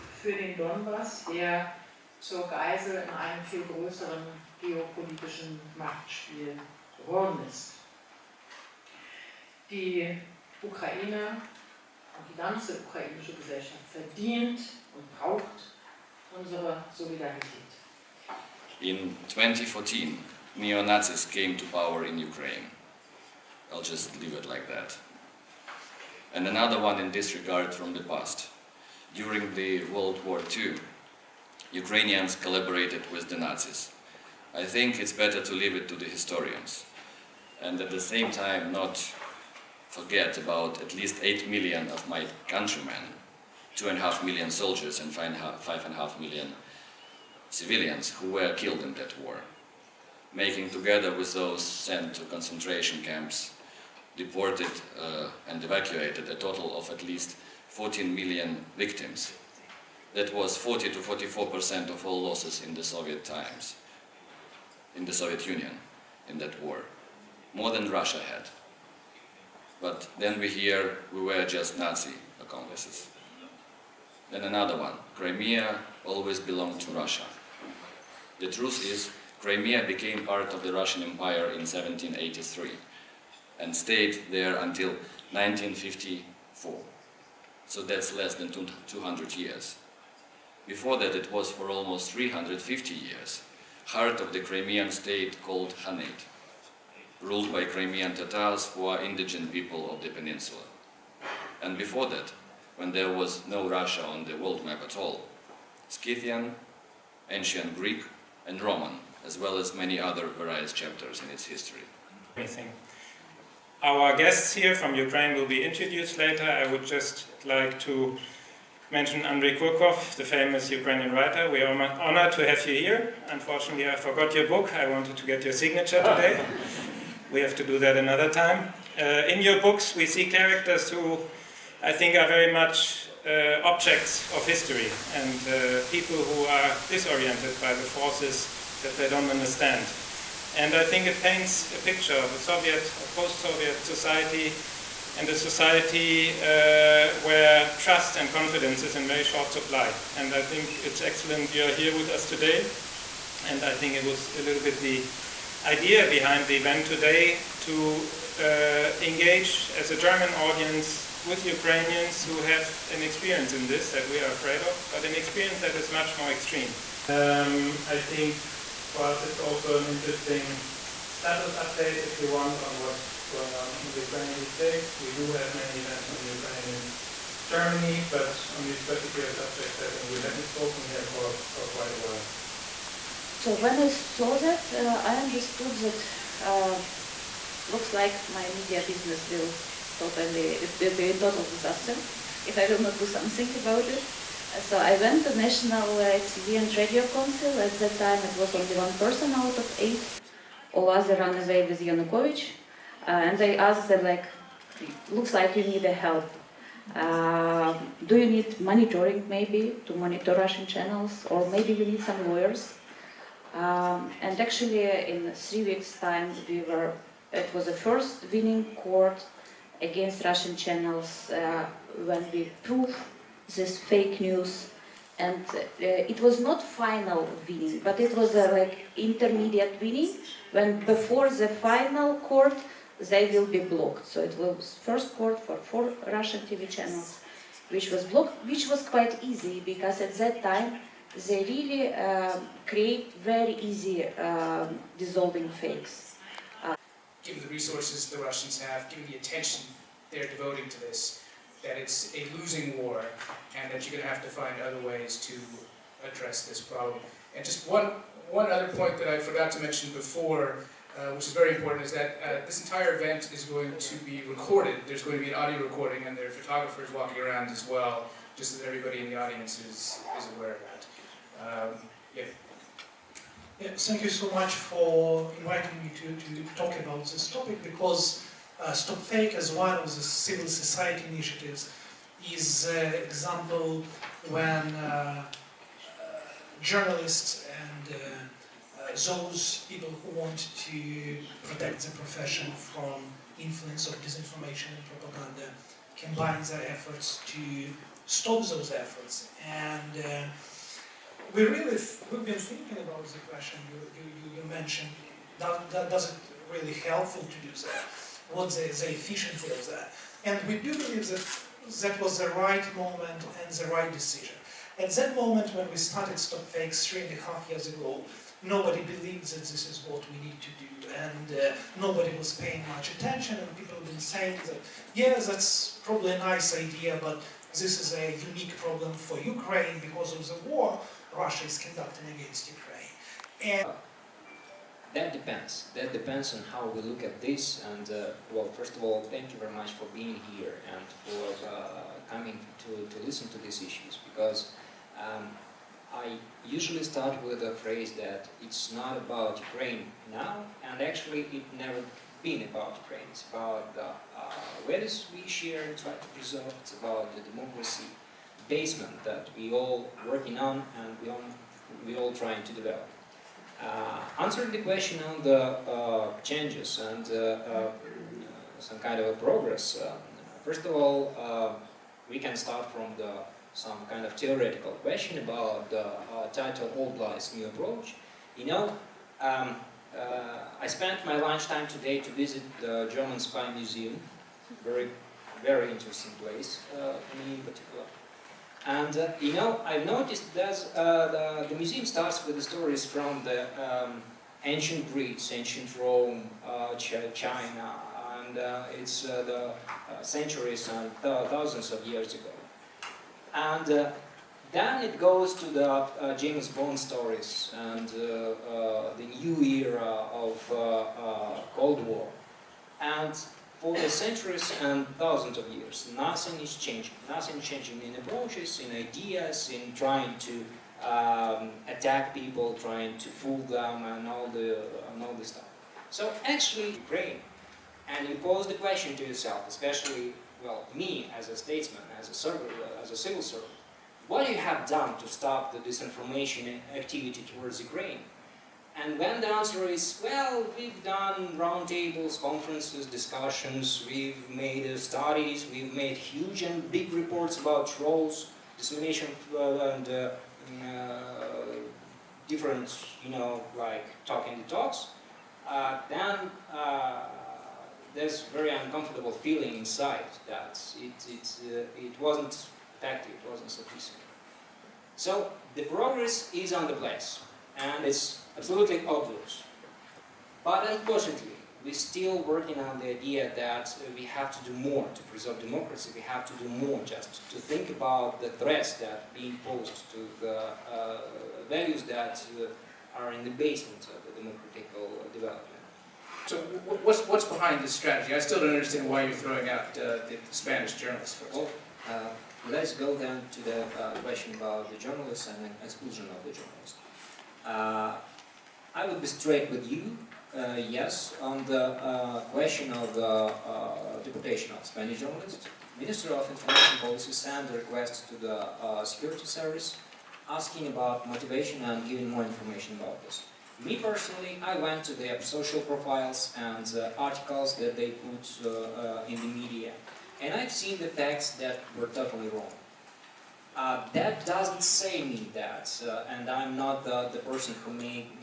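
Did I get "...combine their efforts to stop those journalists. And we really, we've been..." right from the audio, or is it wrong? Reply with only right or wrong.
wrong.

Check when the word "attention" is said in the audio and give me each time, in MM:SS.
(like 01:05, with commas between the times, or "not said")
04:09, 05:22.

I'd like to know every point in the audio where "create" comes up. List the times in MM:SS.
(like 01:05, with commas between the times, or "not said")
04:02.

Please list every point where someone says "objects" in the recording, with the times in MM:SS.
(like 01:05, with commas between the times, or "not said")
02:13.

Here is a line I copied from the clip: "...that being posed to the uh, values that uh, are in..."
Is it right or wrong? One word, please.
right.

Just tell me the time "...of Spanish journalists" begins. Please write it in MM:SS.
08:24.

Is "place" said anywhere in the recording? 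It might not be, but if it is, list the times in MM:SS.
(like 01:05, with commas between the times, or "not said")
06:26, 07:46.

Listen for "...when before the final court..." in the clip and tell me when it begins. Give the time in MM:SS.
03:50.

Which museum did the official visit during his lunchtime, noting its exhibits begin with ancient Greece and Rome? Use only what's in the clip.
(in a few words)
German Spy Museum.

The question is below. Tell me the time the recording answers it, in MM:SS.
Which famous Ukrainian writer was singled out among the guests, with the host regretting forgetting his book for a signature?
01:59.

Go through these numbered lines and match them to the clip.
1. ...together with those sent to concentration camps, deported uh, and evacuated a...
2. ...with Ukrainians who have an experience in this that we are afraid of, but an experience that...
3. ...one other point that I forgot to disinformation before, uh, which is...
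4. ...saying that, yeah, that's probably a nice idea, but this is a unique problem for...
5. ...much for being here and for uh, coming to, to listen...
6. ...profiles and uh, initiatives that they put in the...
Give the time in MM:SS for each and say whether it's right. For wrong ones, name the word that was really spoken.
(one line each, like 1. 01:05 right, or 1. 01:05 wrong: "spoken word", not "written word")
1. 00:50 right
2. 02:41 right
3. 04:18 wrong: "mention", not "disinformation"
4. 05:23 right
5. 05:39 right
6. 08:35 wrong: "articles", not "initiatives".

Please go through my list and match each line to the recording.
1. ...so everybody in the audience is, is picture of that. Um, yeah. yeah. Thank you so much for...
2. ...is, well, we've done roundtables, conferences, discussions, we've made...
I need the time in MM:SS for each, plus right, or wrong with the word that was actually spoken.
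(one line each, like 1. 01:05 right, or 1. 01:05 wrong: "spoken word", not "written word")
1. 04:28 wrong: "aware", not "picture"
2. 07:19 right.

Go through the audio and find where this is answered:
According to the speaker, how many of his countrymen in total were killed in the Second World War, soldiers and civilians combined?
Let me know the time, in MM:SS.
00:41.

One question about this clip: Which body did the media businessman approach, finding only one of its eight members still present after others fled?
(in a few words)
National TV and Radio Council.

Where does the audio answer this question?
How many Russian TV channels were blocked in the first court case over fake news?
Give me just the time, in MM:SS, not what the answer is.
03:55.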